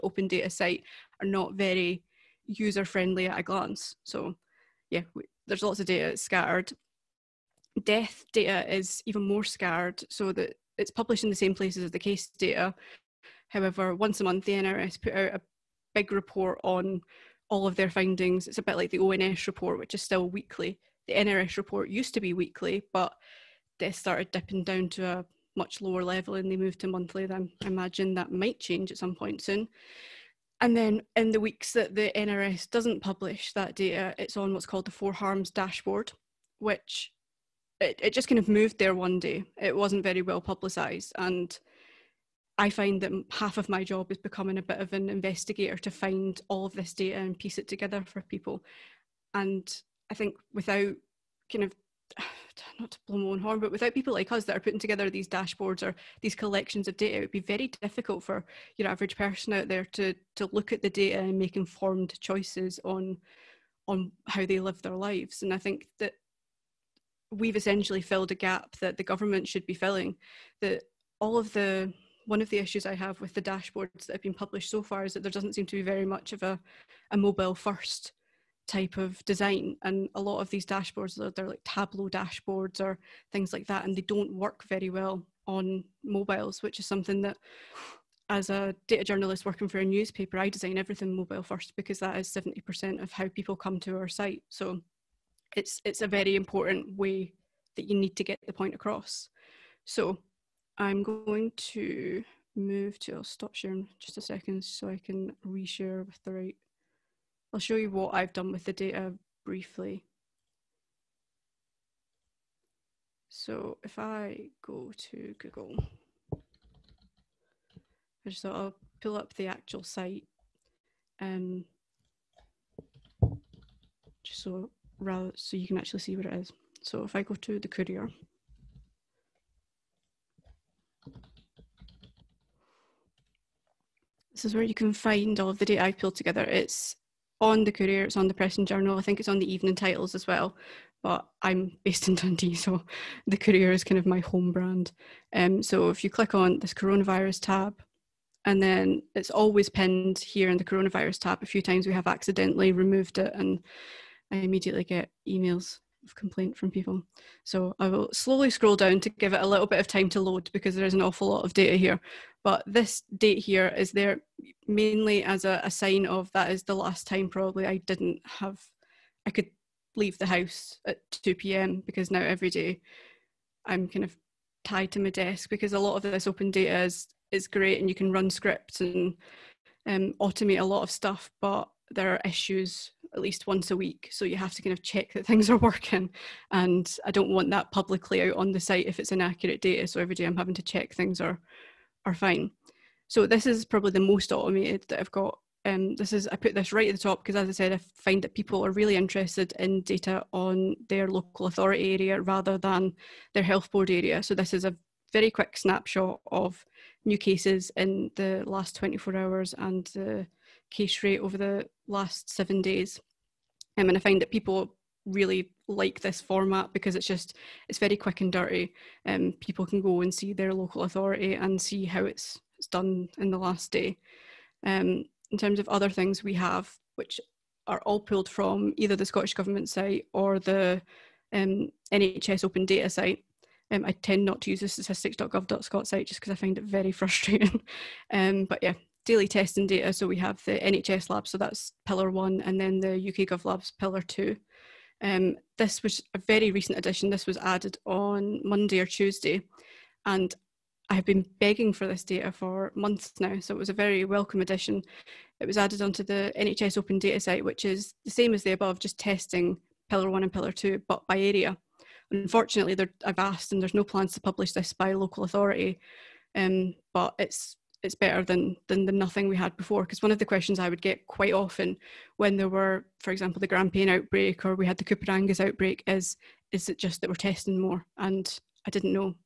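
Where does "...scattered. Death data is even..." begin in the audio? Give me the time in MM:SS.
00:06.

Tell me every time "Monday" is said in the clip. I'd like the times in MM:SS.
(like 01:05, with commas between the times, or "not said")
04:08.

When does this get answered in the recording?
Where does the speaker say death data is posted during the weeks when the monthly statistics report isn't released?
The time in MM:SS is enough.
00:34.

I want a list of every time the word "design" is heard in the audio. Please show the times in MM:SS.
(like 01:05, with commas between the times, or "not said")
01:19, 01:30.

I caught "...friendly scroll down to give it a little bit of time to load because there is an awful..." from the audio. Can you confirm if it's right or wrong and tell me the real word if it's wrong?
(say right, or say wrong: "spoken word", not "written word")
wrong: "slowly", not "friendly".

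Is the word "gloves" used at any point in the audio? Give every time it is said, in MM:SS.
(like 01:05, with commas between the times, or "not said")
not said.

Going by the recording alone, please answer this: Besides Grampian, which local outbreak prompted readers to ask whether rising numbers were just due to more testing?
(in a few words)
Coupar Angus.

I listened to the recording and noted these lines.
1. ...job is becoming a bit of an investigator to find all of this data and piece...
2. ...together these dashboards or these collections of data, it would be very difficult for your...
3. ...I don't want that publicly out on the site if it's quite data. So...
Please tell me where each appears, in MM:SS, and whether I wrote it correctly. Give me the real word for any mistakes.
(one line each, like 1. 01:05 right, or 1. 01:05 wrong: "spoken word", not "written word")
1. 00:43 right
2. 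00:54 right
3. 03:07 wrong: "inaccurate", not "quite".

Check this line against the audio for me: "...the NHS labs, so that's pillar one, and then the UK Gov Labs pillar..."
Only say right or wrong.
right.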